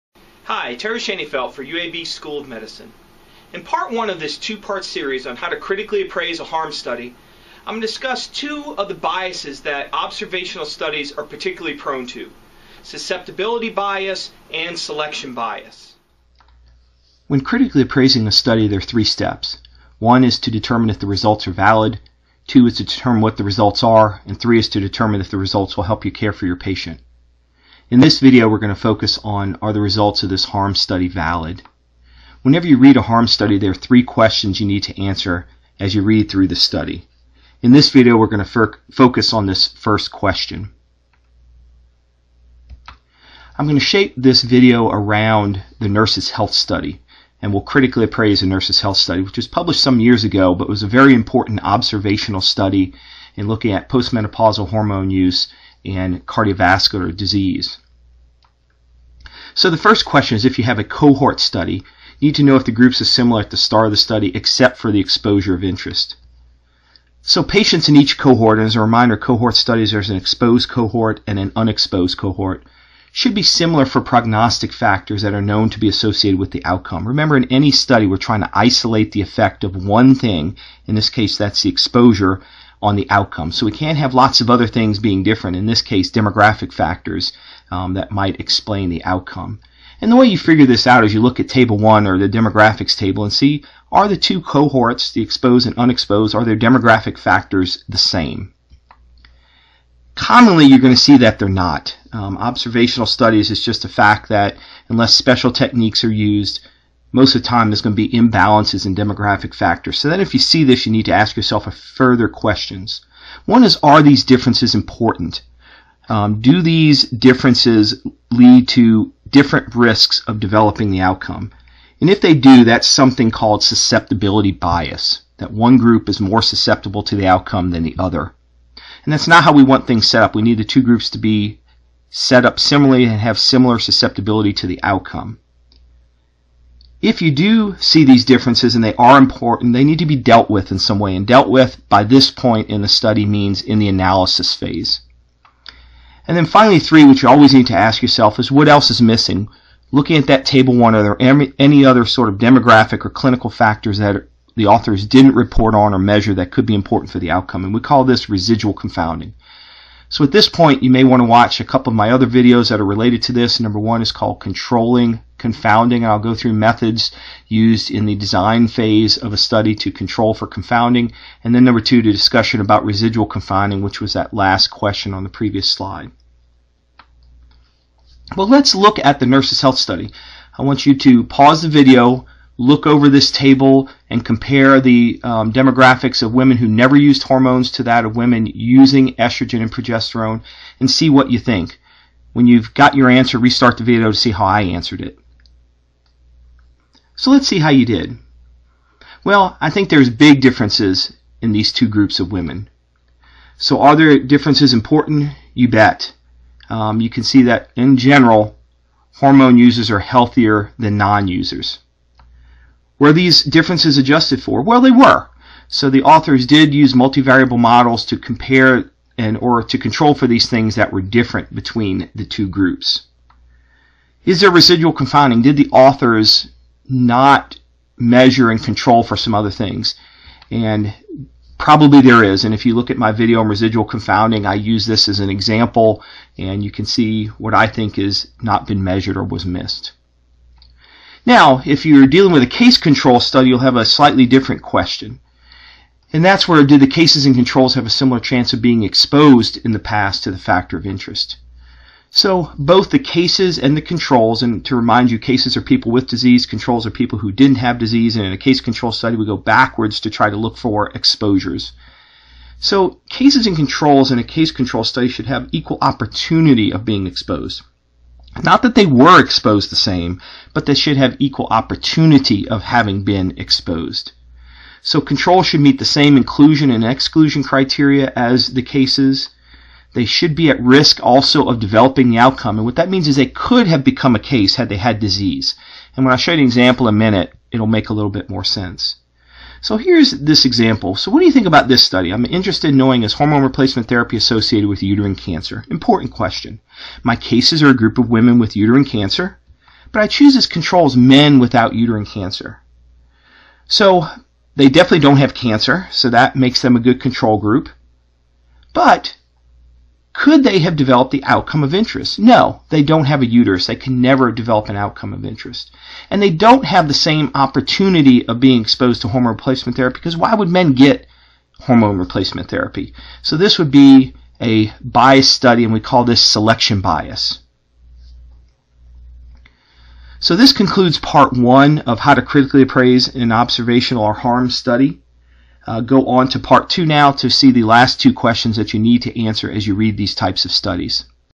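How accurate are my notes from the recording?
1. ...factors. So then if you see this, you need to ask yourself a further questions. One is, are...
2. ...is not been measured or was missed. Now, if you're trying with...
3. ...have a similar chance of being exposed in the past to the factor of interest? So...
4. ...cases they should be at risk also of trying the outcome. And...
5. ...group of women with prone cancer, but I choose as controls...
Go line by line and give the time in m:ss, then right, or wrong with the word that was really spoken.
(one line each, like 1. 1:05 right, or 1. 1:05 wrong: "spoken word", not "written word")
1. 1:49 right
2. 3:57 wrong: "dealing", not "trying"
3. 4:07 right
4. 4:38 wrong: "developing", not "trying"
5. 4:57 wrong: "uterine", not "prone".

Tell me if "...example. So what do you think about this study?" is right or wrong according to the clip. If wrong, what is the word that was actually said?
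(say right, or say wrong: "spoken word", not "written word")
right.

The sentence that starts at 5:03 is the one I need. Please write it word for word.
So they definitely don't have cancer, so that makes them a good control group.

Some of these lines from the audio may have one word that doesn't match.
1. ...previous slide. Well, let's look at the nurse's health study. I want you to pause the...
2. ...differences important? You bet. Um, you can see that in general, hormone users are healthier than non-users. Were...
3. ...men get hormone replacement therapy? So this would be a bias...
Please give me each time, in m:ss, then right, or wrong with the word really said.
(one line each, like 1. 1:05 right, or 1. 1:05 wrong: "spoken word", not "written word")
1. 2:55 right
2. 3:24 right
3. 5:20 right.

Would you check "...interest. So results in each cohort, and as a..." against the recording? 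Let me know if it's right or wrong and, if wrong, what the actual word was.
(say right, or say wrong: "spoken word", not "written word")
wrong: "patients", not "results".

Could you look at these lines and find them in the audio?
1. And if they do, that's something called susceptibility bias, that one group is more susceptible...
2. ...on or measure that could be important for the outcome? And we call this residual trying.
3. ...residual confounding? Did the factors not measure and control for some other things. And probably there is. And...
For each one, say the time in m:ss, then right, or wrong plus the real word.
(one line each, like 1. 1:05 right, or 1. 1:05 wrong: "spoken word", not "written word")
1. 2:01 right
2. 2:35 wrong: "confounding", not "trying"
3. 3:44 wrong: "authors", not "factors".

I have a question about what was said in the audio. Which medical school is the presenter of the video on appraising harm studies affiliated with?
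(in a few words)
UAB School of Medicine.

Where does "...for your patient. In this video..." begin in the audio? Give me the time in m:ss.
0:26.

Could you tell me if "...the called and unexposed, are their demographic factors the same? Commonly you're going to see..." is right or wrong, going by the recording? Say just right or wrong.
wrong.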